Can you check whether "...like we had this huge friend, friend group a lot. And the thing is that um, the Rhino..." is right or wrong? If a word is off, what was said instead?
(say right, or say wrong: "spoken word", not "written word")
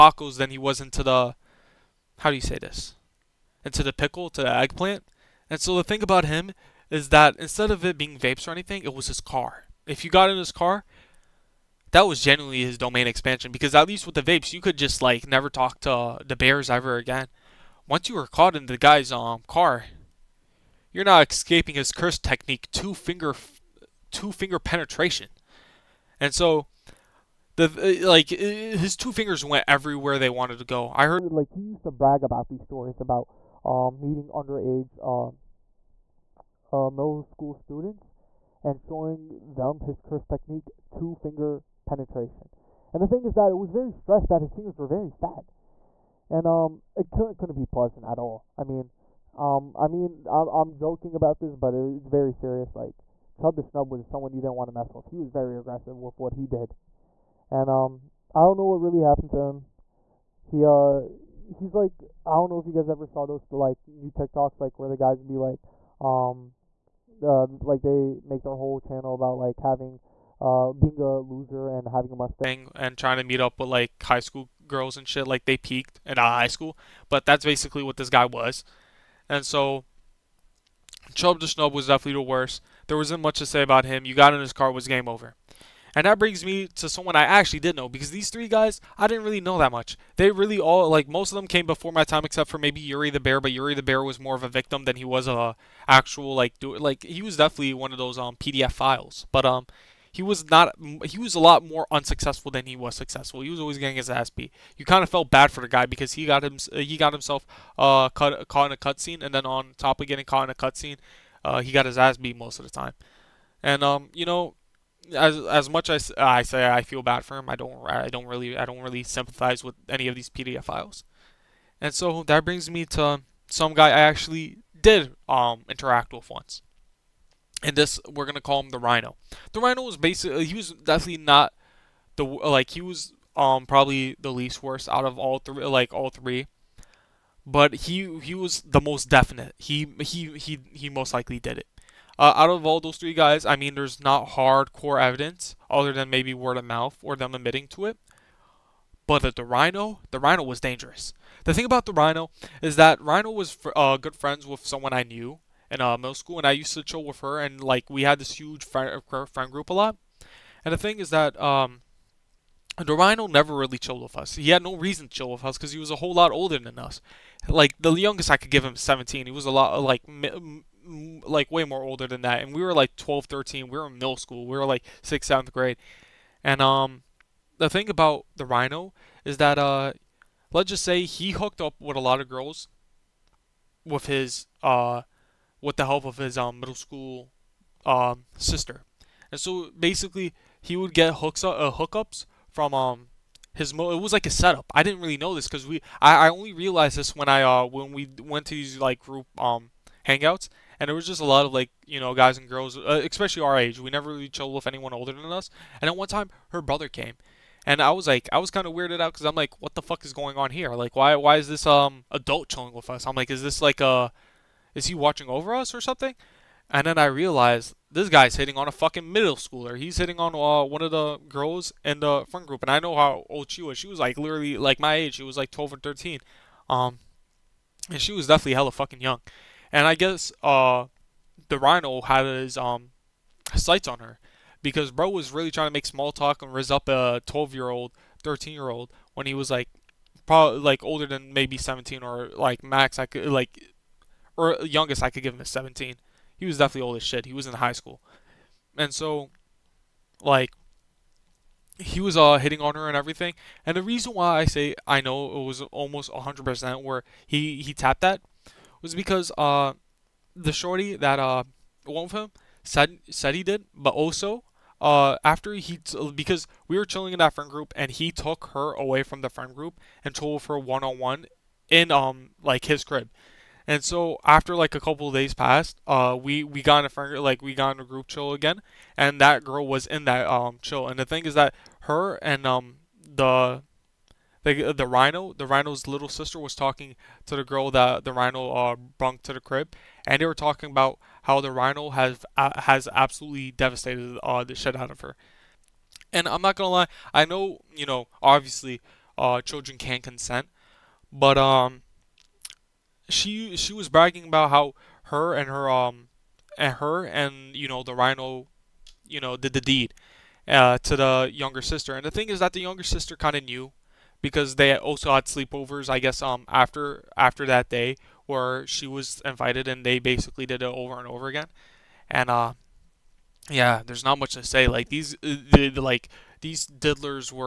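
right.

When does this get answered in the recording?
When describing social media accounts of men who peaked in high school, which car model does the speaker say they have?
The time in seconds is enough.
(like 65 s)
72 s.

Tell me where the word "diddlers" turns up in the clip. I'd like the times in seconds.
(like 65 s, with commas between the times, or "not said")
326 s.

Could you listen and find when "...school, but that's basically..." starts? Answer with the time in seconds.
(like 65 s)
76 s.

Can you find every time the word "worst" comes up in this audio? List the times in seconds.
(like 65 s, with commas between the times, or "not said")
82 s, 134 s.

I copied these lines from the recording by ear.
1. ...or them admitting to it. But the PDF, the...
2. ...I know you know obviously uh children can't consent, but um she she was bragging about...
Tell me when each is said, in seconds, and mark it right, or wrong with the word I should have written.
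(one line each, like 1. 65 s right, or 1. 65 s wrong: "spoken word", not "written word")
1. 147 s wrong: "Rhino", not "PDF"
2. 297 s right.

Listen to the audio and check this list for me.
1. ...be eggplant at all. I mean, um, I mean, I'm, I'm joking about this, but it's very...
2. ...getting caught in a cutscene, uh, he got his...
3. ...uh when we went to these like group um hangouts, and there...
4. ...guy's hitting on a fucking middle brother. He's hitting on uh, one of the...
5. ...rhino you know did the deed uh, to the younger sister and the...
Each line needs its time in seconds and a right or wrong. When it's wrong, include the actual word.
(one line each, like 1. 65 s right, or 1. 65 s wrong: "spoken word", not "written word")
1. 47 s wrong: "pleasant", not "eggplant"
2. 110 s right
3. 197 s right
4. 218 s wrong: "schooler", not "brother"
5. 307 s right.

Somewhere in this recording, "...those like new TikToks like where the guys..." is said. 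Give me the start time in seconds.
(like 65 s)
63 s.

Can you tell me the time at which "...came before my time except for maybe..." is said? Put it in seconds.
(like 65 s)
91 s.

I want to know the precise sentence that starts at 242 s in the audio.
I could like or youngest I could give him is 17.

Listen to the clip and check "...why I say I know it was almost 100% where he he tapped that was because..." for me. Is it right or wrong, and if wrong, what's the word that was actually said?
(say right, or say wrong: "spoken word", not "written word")
right.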